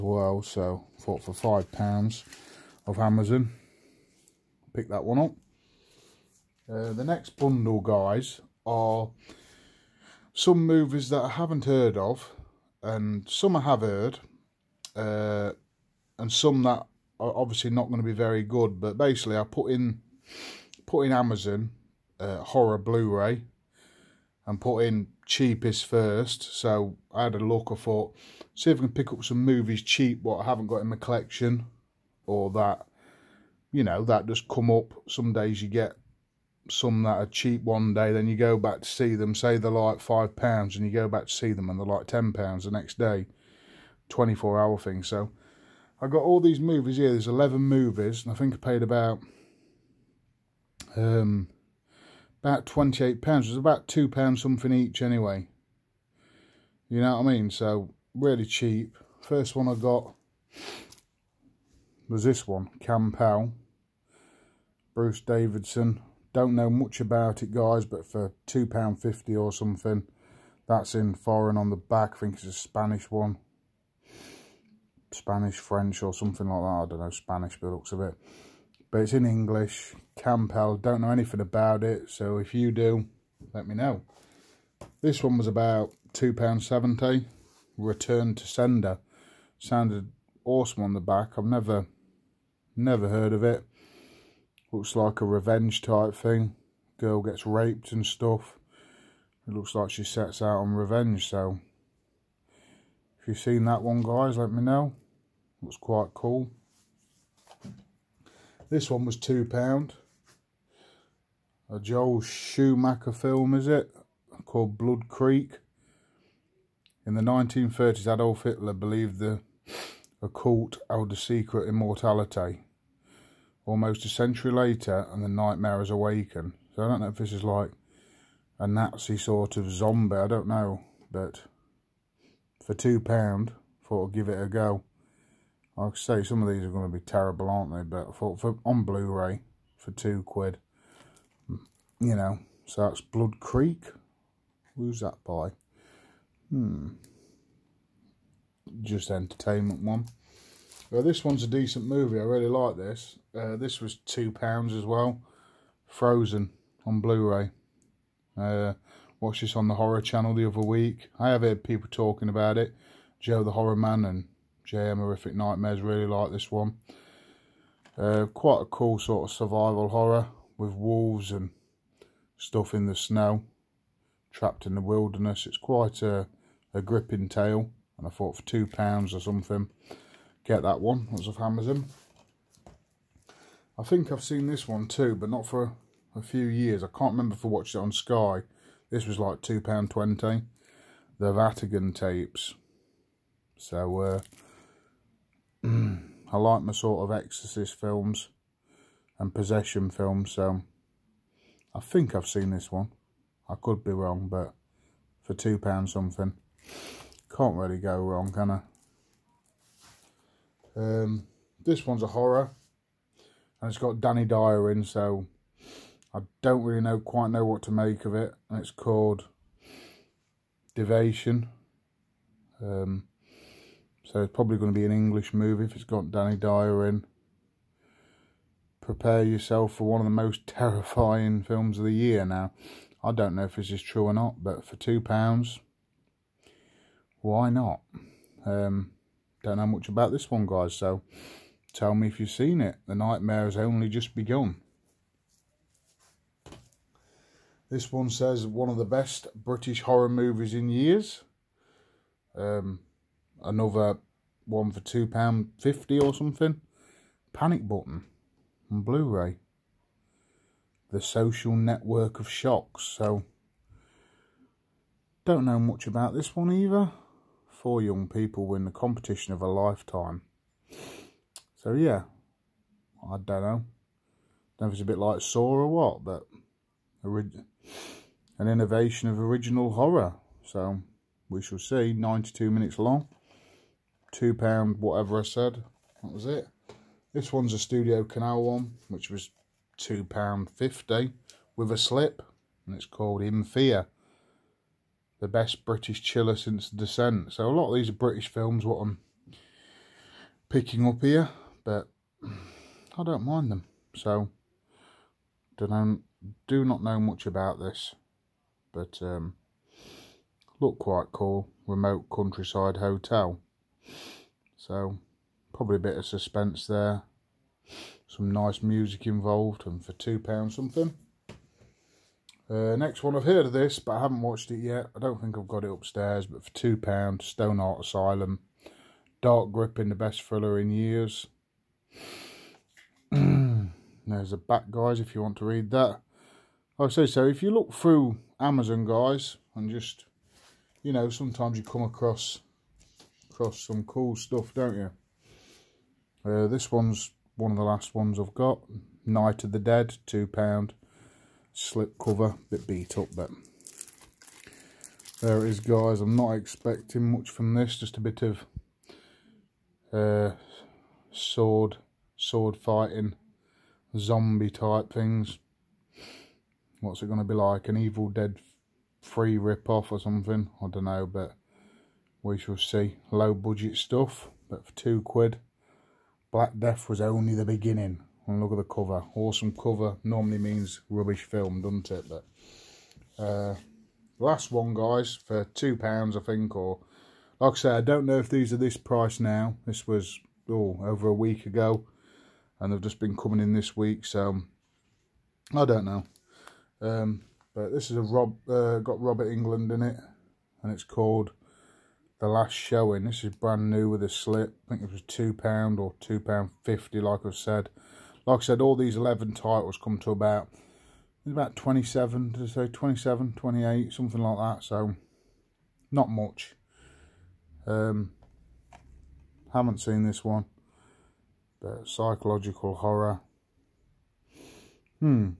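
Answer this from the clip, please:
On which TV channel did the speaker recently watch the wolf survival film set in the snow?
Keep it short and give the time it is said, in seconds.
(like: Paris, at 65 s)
Horror Channel, at 159 s.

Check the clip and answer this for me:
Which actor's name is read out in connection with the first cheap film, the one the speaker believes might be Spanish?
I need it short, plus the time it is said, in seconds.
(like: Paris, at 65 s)
Bruce Davidson, at 64 s.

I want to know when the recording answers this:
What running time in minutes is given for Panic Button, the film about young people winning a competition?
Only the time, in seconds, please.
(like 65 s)
281 s.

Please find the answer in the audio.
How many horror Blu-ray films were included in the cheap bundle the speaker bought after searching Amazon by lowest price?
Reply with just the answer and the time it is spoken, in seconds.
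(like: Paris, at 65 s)
11, at 47 s.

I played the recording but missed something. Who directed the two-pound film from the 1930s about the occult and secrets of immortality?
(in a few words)
Joel Schumacher.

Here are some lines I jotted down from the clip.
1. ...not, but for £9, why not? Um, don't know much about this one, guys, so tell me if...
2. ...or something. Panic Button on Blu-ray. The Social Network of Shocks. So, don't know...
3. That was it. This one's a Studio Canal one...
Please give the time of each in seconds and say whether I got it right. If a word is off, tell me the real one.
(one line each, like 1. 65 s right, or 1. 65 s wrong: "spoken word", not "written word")
1. 234 s wrong: "2", not "9"
2. 256 s right
3. 286 s right.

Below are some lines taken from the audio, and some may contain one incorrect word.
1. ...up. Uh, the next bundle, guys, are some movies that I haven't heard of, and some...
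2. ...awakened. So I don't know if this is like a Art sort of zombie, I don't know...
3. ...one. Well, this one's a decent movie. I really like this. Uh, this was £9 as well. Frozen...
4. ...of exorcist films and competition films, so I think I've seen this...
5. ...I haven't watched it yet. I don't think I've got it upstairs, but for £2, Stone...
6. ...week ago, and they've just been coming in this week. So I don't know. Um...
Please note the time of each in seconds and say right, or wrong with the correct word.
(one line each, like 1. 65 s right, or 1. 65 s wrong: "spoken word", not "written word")
1. 5 s right
2. 125 s wrong: "Nazi", not "Art"
3. 149 s wrong: "2", not "9"
4. 197 s wrong: "possession", not "competition"
5. 323 s right
6. 391 s right.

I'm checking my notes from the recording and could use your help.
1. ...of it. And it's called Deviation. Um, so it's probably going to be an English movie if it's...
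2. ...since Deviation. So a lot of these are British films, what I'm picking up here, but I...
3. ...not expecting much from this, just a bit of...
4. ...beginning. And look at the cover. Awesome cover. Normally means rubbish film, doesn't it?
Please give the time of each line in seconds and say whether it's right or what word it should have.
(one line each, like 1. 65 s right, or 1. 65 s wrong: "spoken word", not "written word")
1. 218 s right
2. 296 s wrong: "Descent", not "Deviation"
3. 356 s right
4. 377 s right.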